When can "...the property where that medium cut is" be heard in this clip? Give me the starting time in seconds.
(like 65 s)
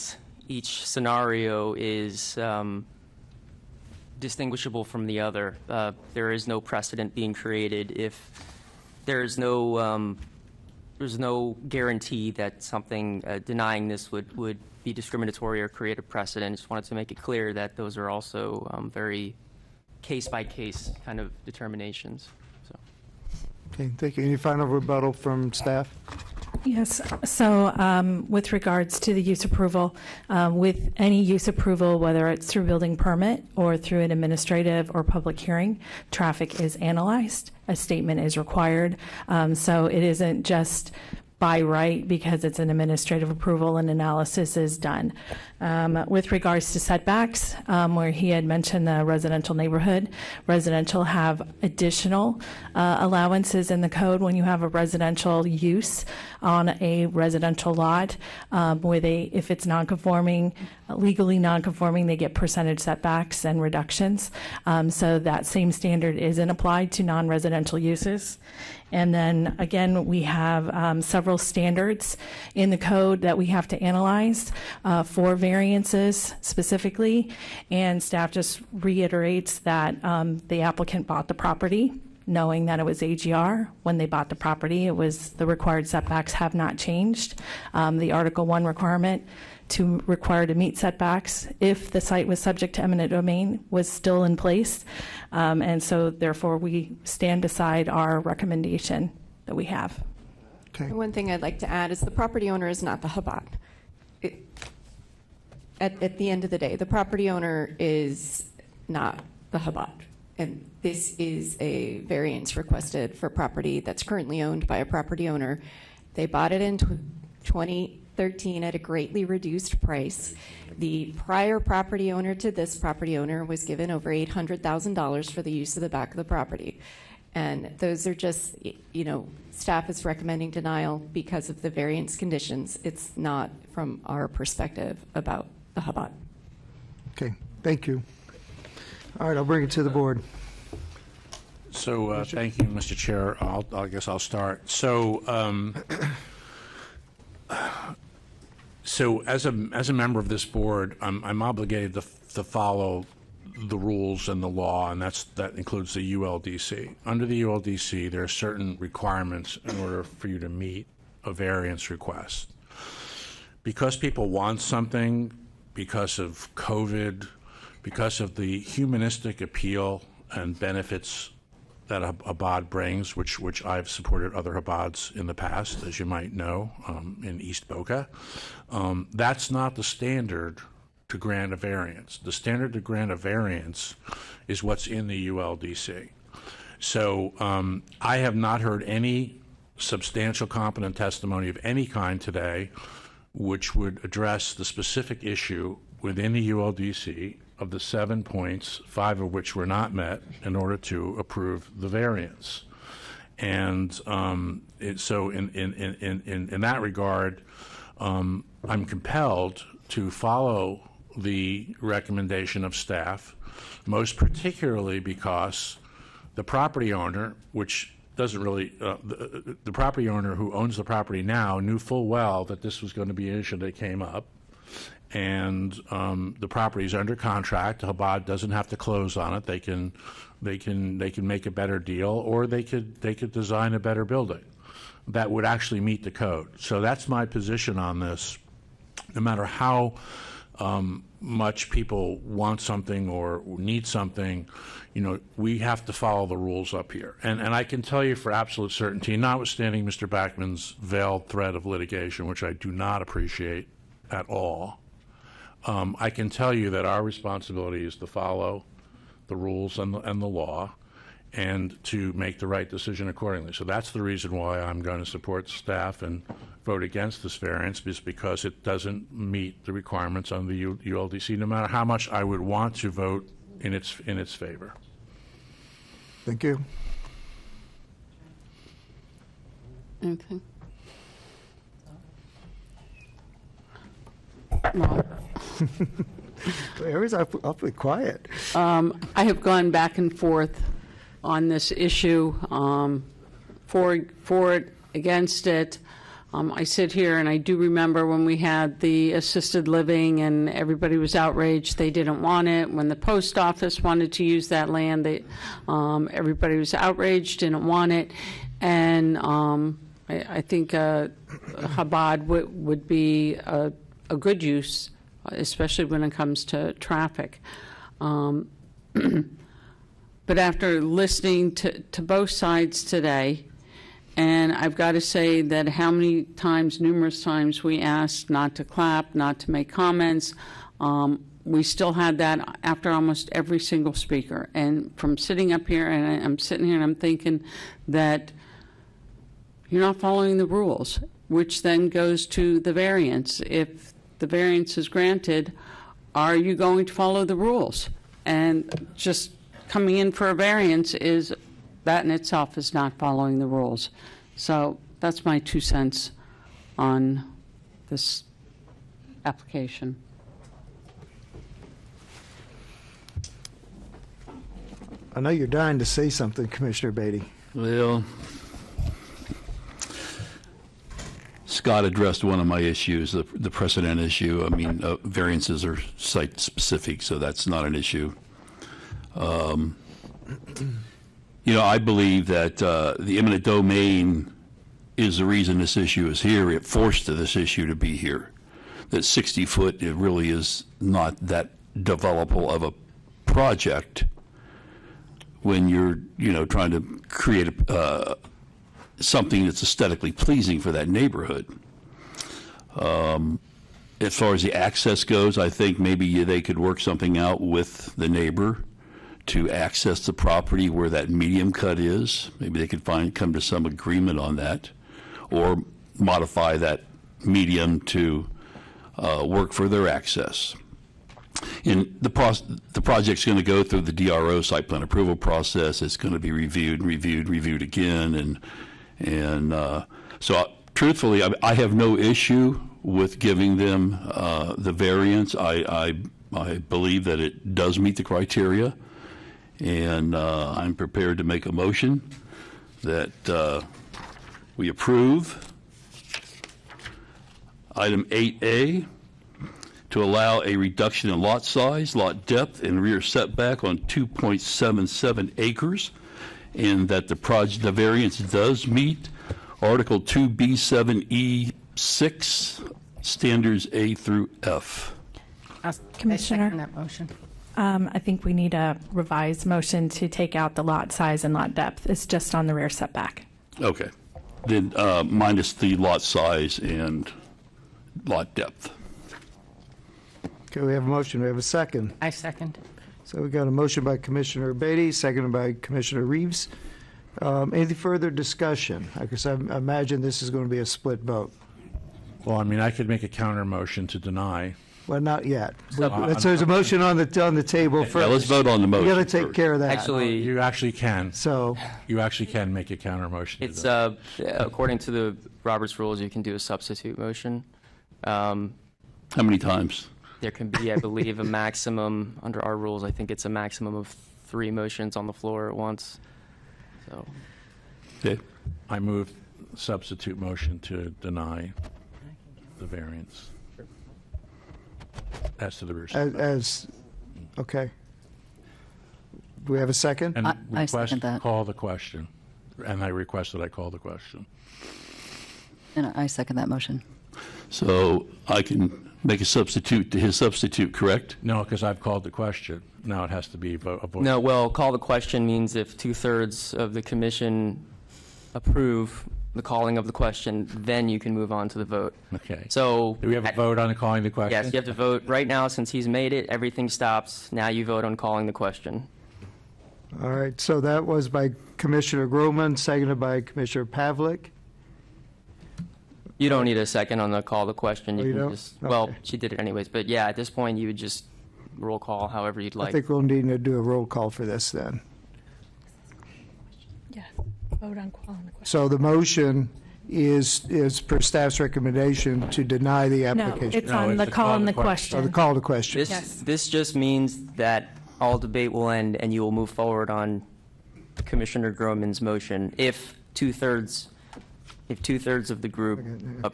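410 s.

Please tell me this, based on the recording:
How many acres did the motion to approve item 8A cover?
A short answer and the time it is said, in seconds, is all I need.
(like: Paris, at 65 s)
2.77 acres, at 453 s.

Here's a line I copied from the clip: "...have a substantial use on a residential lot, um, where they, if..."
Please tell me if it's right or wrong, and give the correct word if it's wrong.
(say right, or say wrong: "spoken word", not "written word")
wrong: "residential", not "substantial".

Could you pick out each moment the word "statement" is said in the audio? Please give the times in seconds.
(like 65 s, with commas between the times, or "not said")
37 s.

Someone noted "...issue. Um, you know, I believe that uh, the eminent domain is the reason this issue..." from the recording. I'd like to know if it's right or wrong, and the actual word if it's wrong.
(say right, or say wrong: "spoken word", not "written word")
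right.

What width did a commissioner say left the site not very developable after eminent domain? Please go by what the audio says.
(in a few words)
60 foot.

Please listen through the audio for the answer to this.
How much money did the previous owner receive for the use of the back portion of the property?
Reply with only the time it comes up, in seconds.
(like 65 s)
123 s.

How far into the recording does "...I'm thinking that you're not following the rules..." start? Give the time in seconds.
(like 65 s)
336 s.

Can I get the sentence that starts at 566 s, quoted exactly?
You don't need a second on the call the question.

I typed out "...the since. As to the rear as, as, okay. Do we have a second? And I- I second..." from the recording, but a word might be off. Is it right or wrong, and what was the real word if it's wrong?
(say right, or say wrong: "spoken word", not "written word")
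wrong: "variance", not "since".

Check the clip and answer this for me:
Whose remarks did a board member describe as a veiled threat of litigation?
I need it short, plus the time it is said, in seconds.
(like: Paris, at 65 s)
Mr. Backman, at 249 s.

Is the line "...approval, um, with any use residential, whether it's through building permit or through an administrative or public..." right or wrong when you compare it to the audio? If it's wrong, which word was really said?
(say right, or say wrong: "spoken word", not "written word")
wrong: "approval", not "residential".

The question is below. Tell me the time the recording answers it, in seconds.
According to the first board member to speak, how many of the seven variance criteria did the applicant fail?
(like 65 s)
198 s.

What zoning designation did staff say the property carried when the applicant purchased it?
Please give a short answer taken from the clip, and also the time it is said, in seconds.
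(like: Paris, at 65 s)
AGR, at 83 s.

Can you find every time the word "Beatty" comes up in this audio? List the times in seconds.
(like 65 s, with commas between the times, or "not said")
366 s, 484 s.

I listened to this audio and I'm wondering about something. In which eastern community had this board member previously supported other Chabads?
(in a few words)
East Boca.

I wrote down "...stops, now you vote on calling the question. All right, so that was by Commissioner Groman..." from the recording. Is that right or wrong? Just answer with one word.
right.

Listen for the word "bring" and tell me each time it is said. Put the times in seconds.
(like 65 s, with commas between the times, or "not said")
139 s, 172 s.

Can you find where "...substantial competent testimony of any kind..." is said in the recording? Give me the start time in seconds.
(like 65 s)
189 s.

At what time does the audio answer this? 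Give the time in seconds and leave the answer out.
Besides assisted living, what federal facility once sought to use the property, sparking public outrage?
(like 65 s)
302 s.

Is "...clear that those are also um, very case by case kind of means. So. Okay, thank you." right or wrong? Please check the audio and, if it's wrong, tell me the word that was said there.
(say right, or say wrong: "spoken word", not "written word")
wrong: "determinations", not "means".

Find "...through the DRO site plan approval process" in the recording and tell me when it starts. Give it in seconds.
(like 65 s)
423 s.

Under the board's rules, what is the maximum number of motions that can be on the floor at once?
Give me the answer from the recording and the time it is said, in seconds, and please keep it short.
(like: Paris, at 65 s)
3, at 514 s.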